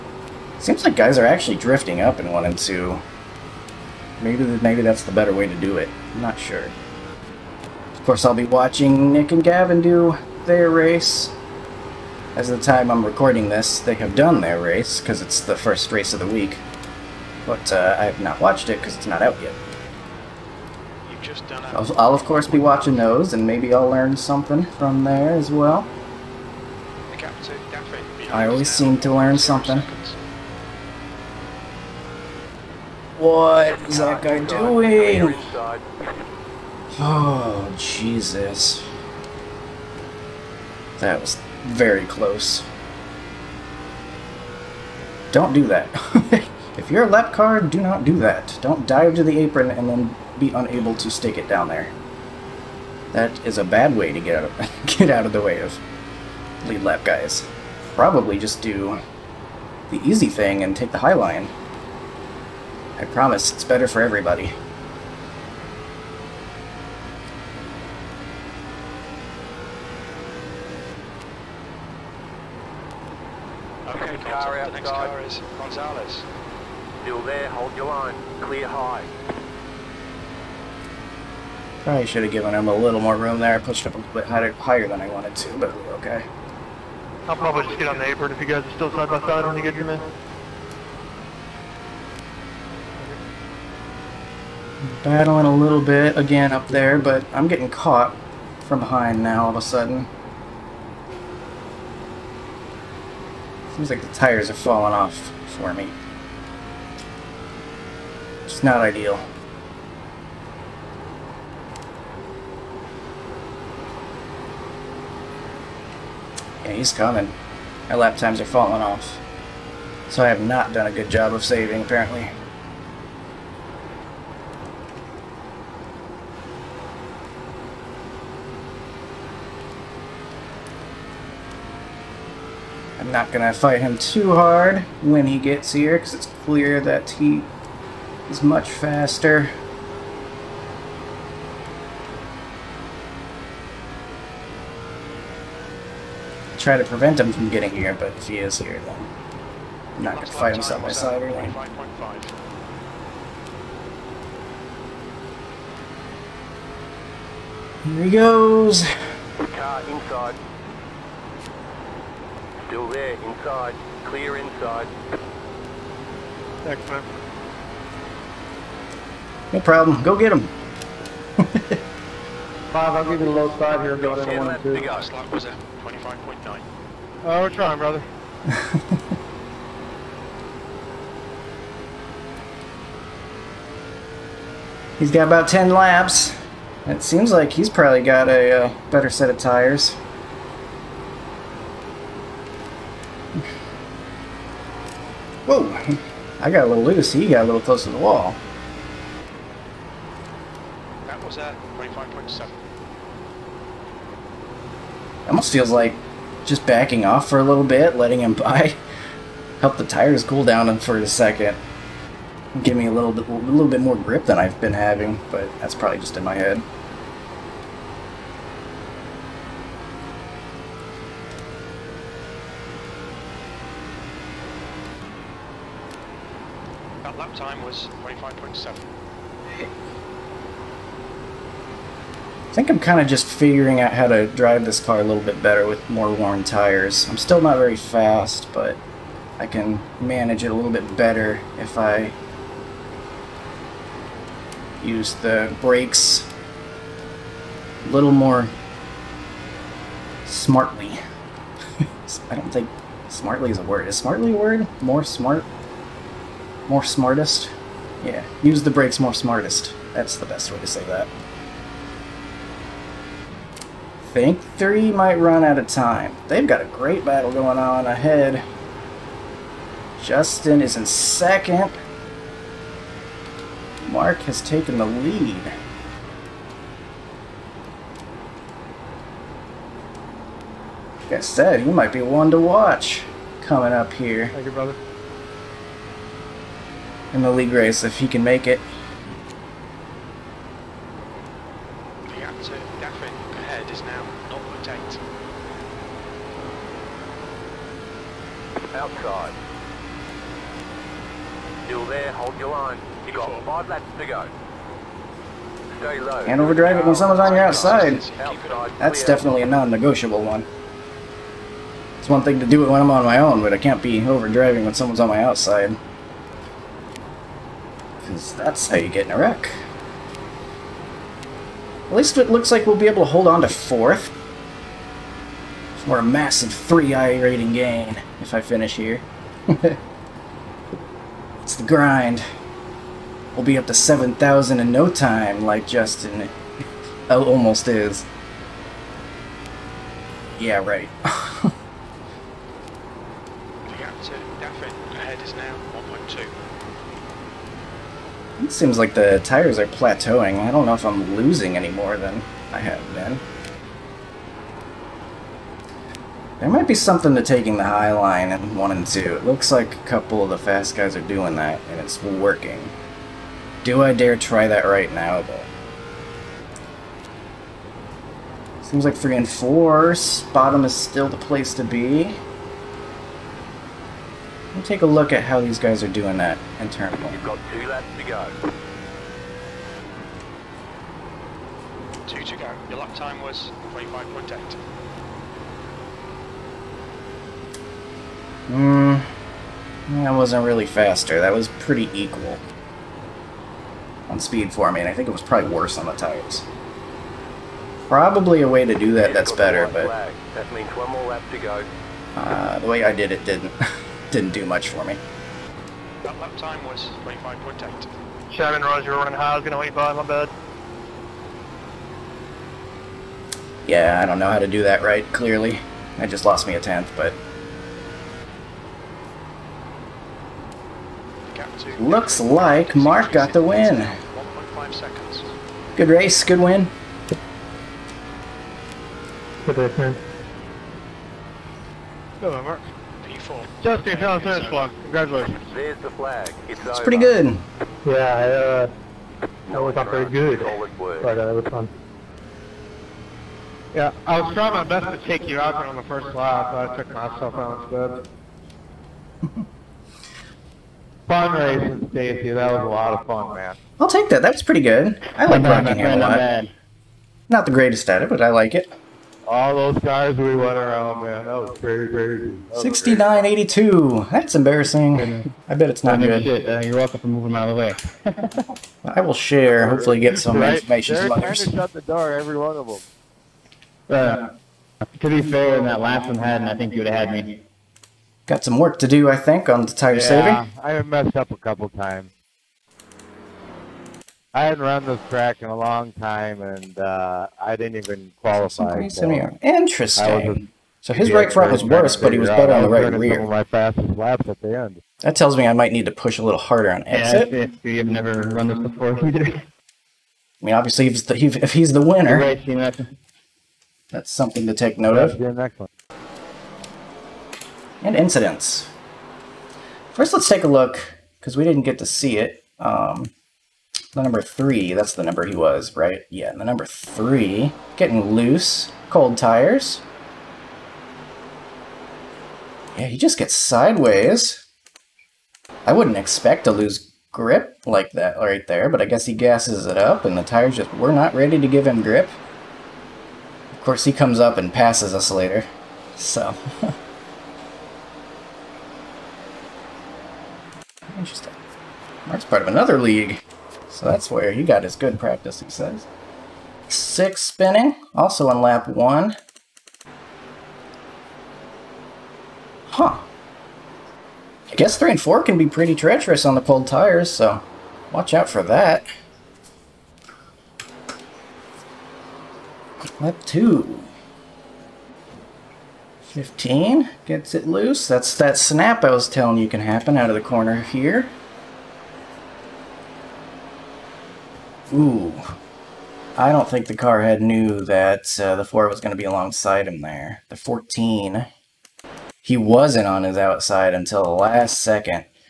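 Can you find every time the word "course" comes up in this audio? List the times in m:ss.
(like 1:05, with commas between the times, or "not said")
0:08, 0:22, 8:53.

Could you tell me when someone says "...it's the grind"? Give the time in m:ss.
5:31.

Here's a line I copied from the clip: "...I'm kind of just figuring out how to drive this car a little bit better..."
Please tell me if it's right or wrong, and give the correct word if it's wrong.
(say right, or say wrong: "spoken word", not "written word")
right.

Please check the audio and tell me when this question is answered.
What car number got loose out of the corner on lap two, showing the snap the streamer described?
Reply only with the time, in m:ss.
9:26.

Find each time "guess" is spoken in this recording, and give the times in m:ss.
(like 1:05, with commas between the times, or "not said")
8:48, 9:14.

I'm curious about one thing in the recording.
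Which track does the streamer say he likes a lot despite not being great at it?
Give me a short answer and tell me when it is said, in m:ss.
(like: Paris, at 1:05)
Rockingham, at 7:35.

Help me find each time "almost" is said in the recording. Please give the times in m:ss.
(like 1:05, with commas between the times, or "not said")
3:25, 5:37.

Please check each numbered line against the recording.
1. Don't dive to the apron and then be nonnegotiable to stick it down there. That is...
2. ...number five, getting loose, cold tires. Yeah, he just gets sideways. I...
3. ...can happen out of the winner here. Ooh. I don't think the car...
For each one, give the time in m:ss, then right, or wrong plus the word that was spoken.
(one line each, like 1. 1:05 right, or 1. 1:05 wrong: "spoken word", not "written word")
1. 0:48 wrong: "unable", not "nonnegotiable"
2. 8:36 wrong: "three", not "five"
3. 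9:29 wrong: "corner", not "winner".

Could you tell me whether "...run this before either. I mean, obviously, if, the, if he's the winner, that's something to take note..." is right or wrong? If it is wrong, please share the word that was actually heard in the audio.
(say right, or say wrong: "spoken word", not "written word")
right.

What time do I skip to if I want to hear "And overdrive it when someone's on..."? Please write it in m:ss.
5:06.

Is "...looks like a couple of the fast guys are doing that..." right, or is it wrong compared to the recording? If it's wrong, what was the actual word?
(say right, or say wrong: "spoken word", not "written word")
right.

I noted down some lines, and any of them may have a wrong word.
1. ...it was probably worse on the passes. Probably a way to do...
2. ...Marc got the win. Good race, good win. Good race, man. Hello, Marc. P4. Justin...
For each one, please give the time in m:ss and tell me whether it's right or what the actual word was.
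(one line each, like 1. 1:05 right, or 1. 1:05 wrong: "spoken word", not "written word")
1. 6:35 wrong: "tires", not "passes"
2. 7:02 right.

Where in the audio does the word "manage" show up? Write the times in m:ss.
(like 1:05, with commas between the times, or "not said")
3:59.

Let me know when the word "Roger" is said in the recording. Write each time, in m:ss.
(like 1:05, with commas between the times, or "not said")
6:48.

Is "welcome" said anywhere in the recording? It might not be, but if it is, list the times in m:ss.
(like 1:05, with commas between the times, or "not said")
7:46.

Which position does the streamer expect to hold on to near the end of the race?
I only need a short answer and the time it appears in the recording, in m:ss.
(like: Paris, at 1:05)
fourth, at 5:23.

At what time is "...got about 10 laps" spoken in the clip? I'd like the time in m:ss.
3:05.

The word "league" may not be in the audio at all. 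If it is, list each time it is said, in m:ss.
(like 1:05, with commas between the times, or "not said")
4:47, 9:02.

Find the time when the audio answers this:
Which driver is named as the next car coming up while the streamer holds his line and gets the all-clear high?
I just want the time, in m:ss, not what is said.
1:15.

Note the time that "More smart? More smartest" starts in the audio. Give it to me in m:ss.
4:14.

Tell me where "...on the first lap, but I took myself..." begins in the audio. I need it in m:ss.
7:25.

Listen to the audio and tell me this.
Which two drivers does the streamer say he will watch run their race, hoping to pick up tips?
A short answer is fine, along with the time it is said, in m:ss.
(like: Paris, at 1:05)
Nick and Gavin, at 0:09.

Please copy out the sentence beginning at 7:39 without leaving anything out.
All those cars we went around, man.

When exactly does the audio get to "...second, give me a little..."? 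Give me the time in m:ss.
3:31.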